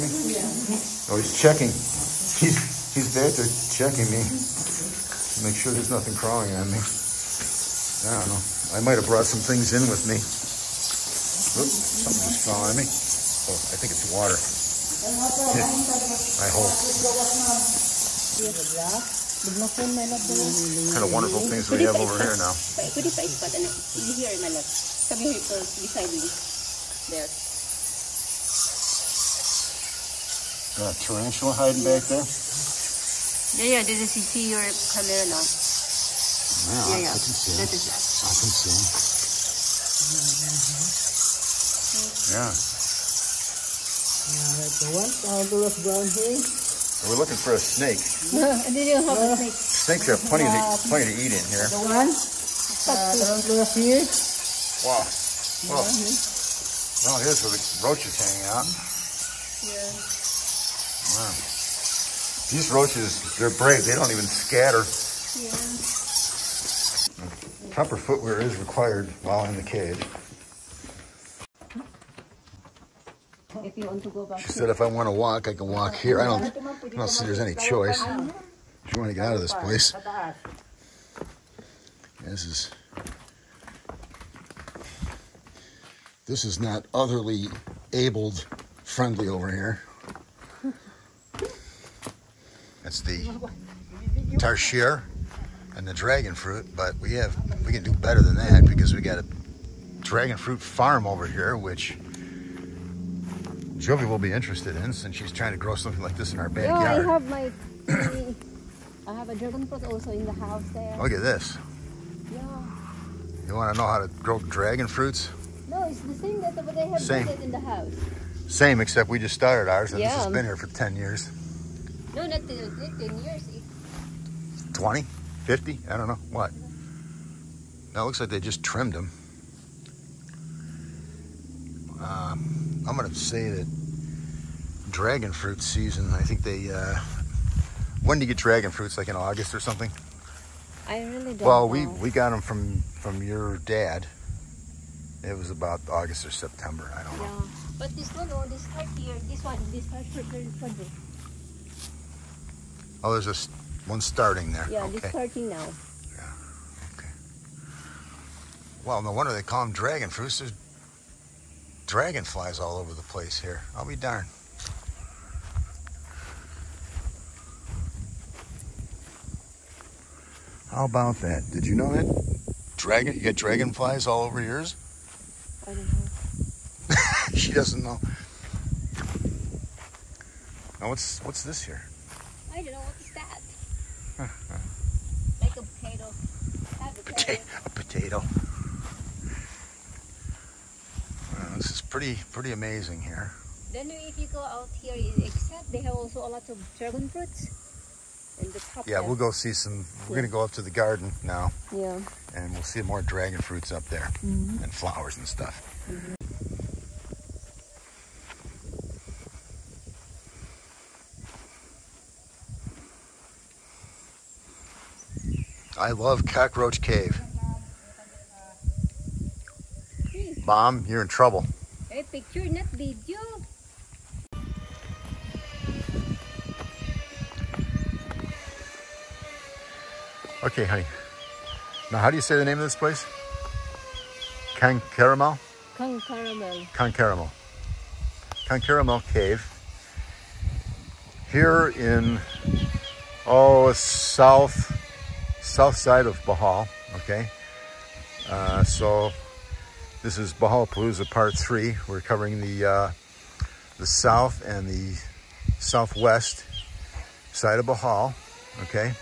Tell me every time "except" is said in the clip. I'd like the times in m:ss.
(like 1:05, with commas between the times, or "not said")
1:58, 3:15.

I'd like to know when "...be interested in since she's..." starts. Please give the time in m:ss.
1:44.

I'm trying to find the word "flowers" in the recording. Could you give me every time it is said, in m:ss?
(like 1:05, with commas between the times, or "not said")
3:24.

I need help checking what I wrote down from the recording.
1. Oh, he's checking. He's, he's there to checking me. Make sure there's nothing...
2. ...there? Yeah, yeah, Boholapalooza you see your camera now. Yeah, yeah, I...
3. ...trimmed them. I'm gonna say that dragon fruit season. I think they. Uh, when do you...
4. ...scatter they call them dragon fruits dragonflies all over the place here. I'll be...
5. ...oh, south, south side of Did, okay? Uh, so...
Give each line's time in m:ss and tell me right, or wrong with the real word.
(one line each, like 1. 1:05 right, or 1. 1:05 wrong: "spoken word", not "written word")
1. 0:01 right
2. 0:32 wrong: "Did", not "Boholapalooza"
3. 2:08 right
4. 2:39 wrong: "wonder", not "scatter"
5. 4:03 wrong: "Bohol", not "Did".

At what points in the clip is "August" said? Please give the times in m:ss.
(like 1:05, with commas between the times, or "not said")
2:19, 2:25.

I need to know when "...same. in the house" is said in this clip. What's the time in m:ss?
1:57.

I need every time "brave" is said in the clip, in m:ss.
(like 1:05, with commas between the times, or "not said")
1:03.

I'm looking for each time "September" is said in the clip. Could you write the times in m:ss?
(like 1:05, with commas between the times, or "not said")
2:26.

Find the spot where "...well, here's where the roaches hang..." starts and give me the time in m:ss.
0:57.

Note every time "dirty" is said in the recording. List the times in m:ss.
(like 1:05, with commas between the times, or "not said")
not said.